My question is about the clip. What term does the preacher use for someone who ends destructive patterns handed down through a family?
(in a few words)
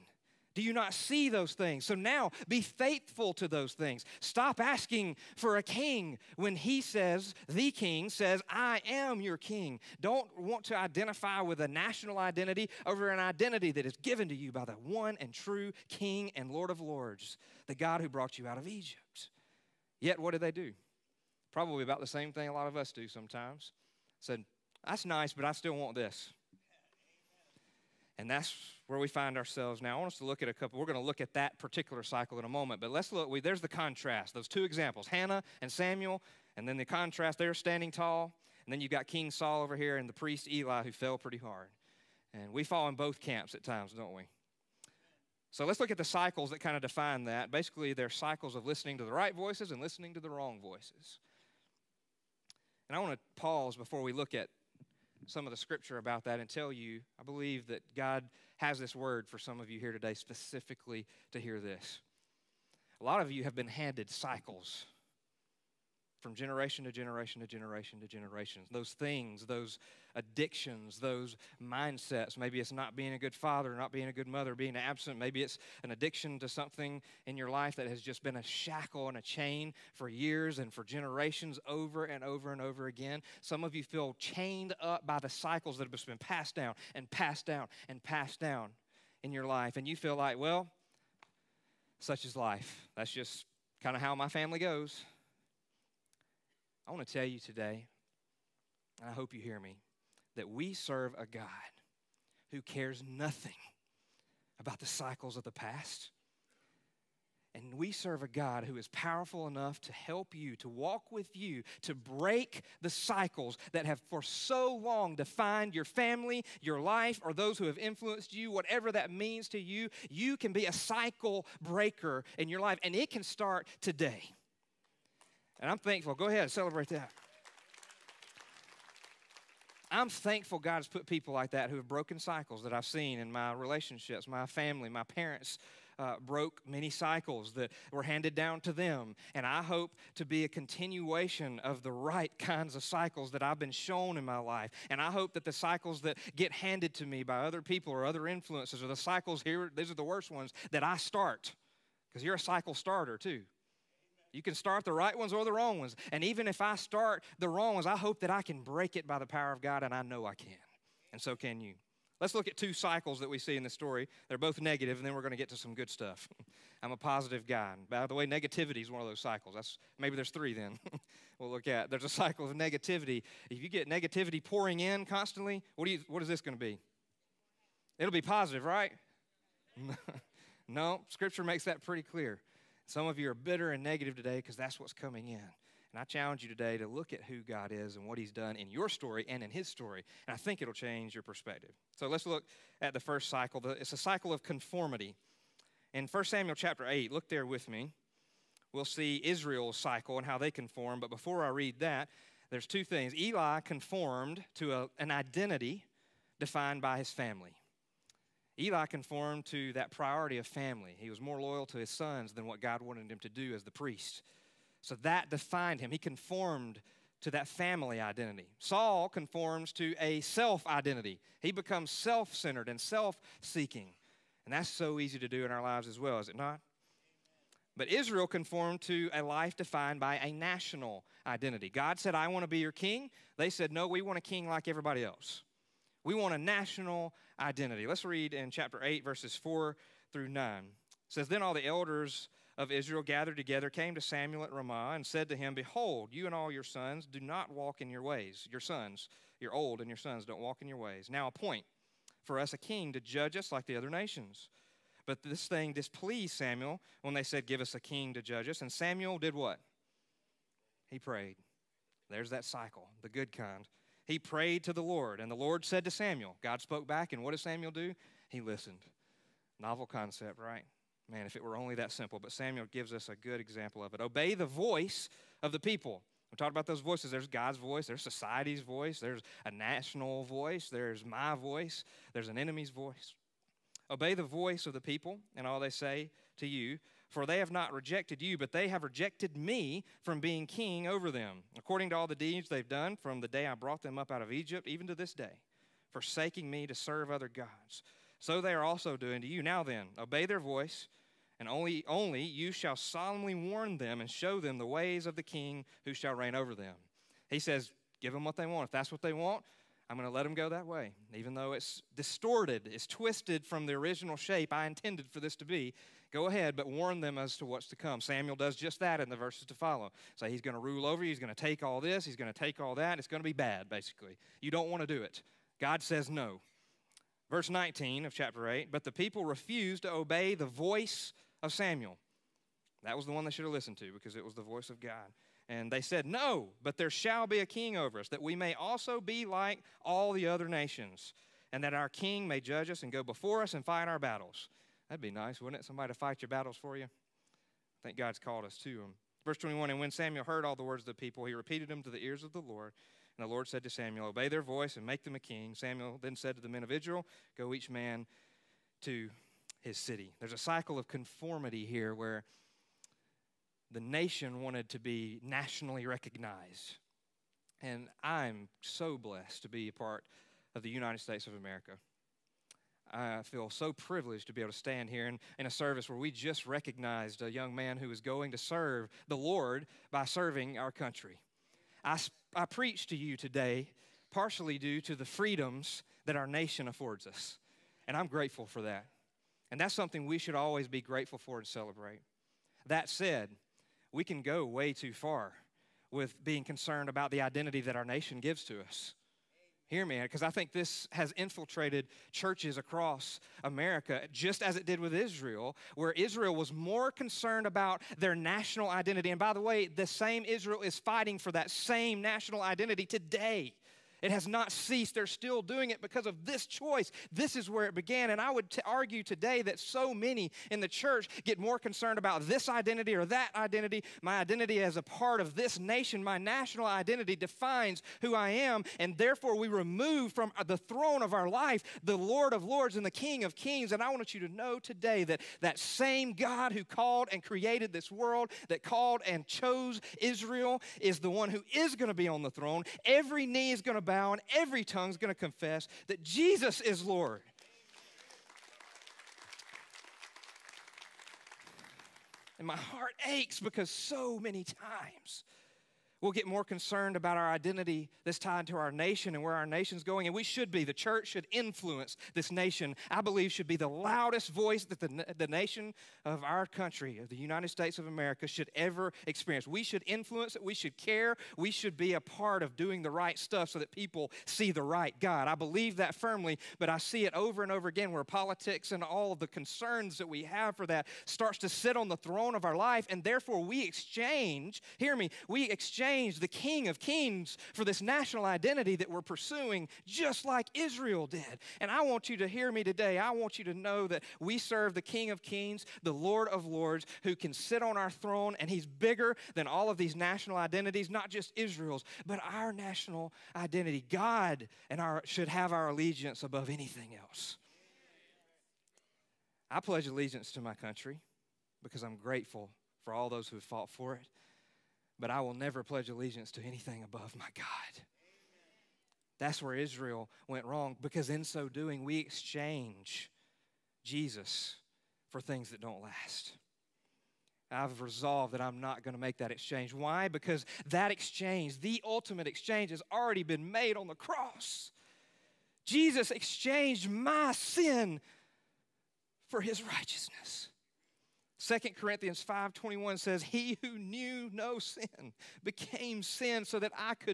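cycle breaker.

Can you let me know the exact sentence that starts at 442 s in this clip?
Every knee is going to bow and every tongue is going to confess that Jesus is Lord.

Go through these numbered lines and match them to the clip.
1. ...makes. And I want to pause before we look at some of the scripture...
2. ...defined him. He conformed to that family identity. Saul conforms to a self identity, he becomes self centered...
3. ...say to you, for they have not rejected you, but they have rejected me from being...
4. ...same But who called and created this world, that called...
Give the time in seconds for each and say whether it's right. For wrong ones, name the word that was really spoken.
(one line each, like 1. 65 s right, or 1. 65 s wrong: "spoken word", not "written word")
1. 50 s wrong: "voices", not "makes"
2. 215 s right
3. 285 s right
4. 435 s wrong: "God", not "But".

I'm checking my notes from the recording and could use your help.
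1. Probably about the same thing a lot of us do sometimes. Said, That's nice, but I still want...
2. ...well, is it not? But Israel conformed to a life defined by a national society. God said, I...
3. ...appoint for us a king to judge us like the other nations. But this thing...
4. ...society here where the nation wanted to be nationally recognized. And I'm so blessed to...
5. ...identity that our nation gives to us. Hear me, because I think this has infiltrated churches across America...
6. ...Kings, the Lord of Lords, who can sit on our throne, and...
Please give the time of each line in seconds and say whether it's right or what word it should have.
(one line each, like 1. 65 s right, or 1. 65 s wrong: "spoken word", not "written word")
1. 21 s right
2. 226 s wrong: "identity", not "society"
3. 251 s right
4. 360 s wrong: "conformity", not "society"
5. 397 s right
6. 495 s right.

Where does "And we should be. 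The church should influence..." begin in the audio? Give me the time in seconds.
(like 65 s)
460 s.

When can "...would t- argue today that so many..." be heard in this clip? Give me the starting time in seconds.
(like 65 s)
418 s.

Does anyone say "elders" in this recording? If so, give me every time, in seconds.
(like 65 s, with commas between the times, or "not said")
241 s.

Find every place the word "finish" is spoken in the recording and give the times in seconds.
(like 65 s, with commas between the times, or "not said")
not said.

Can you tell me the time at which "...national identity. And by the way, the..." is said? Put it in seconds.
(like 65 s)
408 s.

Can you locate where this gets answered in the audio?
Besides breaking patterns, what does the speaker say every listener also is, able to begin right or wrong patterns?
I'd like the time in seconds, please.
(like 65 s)
152 s.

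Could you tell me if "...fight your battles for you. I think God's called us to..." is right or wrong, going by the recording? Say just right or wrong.
right.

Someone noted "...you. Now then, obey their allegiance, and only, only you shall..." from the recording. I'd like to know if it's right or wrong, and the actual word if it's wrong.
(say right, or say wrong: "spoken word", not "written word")
wrong: "voice", not "allegiance".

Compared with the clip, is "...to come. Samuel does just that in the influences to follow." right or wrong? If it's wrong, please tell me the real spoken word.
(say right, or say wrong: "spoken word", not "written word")
wrong: "verses", not "influences".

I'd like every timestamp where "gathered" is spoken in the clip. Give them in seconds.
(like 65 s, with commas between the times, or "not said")
243 s.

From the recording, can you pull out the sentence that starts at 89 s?
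And you feel like, well, such is life.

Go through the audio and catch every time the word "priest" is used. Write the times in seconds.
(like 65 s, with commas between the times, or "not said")
40 s, 213 s.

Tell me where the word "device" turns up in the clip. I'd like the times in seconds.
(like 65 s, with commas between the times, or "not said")
not said.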